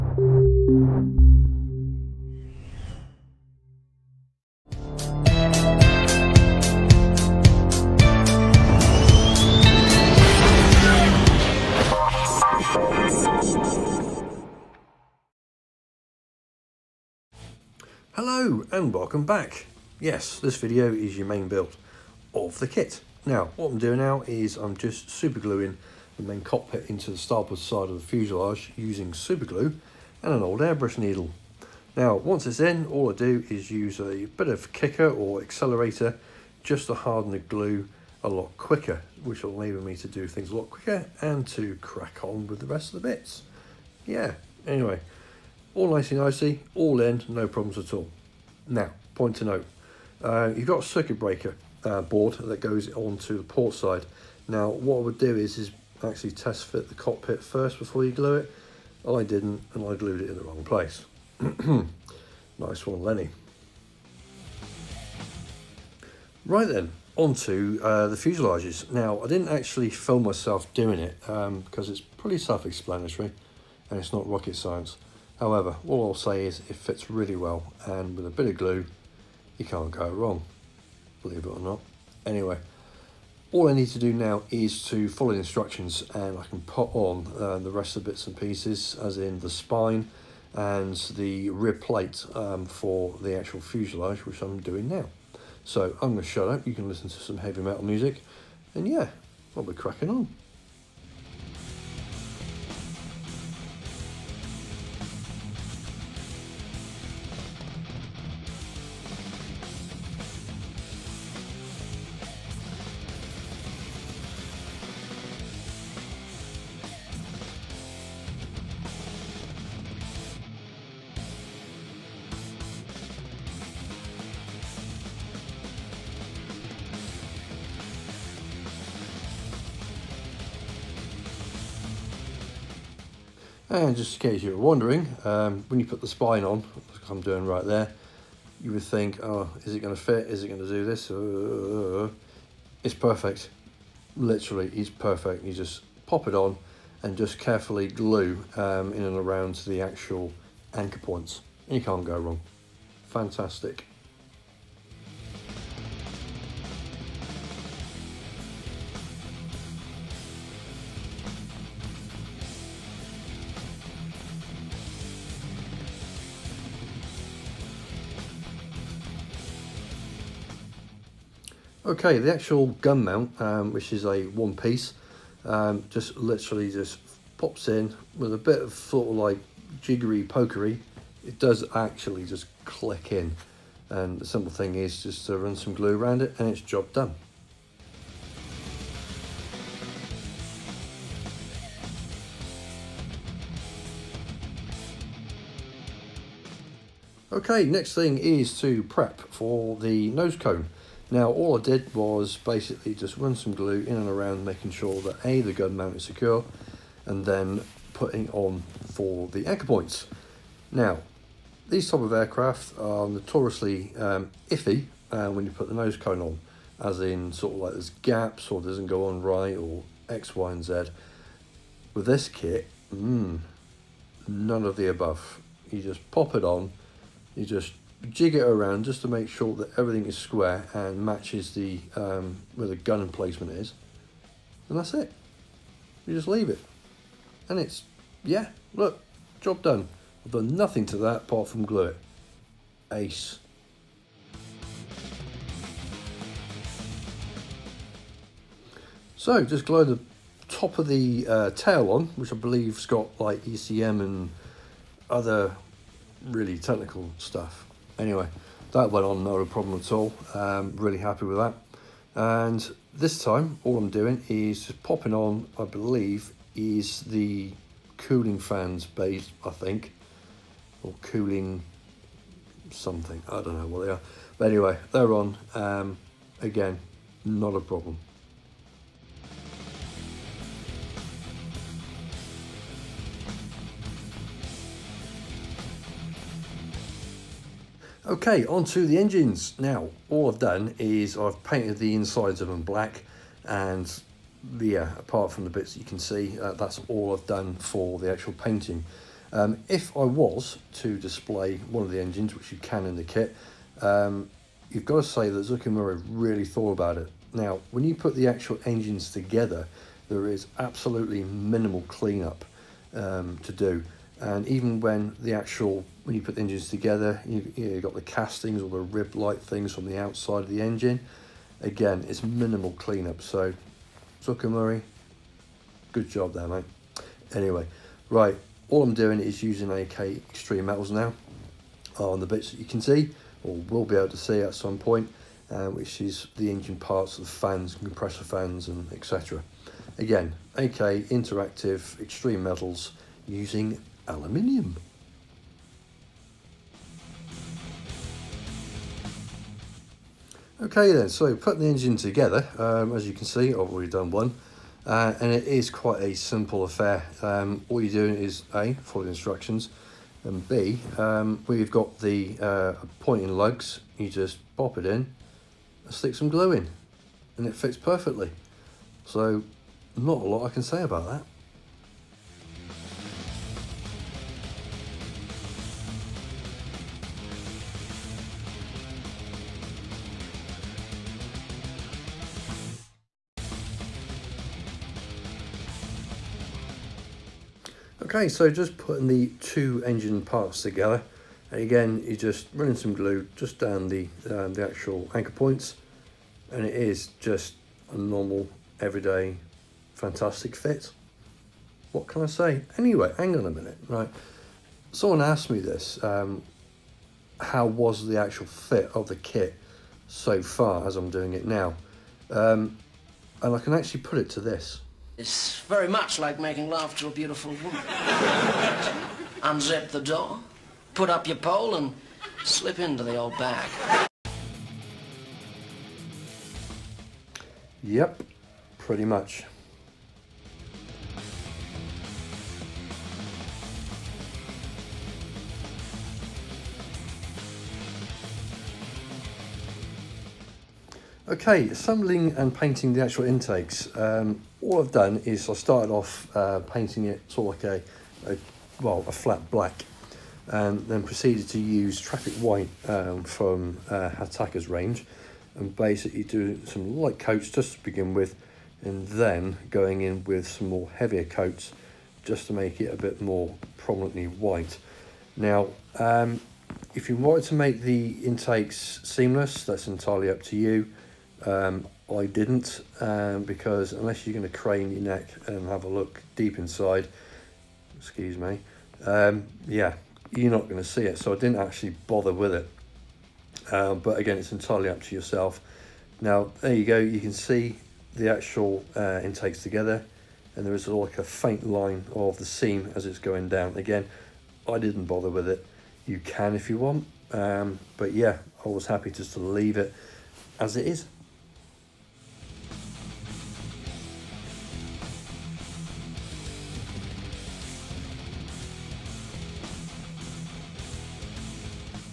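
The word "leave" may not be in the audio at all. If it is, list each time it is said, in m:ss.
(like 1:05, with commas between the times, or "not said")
3:56, 8:19.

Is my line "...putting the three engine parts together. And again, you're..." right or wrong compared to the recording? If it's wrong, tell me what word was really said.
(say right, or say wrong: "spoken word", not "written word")
wrong: "two", not "three".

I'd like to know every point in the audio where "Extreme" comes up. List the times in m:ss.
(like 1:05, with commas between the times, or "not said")
5:30, 5:41.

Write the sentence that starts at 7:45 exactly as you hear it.
Now, um, if you wanted to make the intakes seamless, that's entirely up to you.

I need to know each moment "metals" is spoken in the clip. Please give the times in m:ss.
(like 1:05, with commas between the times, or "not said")
1:37, 5:30, 5:42.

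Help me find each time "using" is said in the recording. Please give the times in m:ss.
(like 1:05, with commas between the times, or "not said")
0:28, 5:29, 5:43.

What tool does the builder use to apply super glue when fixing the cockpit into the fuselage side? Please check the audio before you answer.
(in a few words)
An old airbrush needle.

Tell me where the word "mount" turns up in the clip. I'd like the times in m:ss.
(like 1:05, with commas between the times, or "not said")
2:53, 3:25.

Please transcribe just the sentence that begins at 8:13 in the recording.
Again, I didn't bother with it.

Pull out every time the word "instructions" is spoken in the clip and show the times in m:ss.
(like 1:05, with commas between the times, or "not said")
1:25, 5:59.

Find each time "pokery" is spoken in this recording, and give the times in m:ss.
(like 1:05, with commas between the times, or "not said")
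3:00.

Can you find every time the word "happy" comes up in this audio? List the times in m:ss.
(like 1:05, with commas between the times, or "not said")
4:20, 8:18.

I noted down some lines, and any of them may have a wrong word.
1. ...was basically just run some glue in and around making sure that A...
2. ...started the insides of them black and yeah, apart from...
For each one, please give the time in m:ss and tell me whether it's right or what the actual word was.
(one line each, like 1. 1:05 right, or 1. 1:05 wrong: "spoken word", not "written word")
1. 3:21 right
2. 4:51 wrong: "painted", not "started".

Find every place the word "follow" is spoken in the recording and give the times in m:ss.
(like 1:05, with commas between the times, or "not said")
1:25, 5:58.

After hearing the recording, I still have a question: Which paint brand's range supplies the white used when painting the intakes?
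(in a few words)
Hataka.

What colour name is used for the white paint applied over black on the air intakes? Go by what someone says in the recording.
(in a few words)
Traffic White.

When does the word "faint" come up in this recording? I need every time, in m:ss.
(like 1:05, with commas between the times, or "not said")
8:11.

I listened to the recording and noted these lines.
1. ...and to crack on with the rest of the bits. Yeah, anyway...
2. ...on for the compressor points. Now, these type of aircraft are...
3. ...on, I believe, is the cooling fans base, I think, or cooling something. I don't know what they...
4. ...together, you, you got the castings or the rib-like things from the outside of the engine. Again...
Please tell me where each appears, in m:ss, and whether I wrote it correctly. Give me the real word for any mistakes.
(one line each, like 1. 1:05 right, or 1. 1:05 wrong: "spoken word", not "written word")
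1. 0:41 right
2. 3:28 wrong: "anchor", not "compressor"
3. 4:25 right
4. 5:16 right.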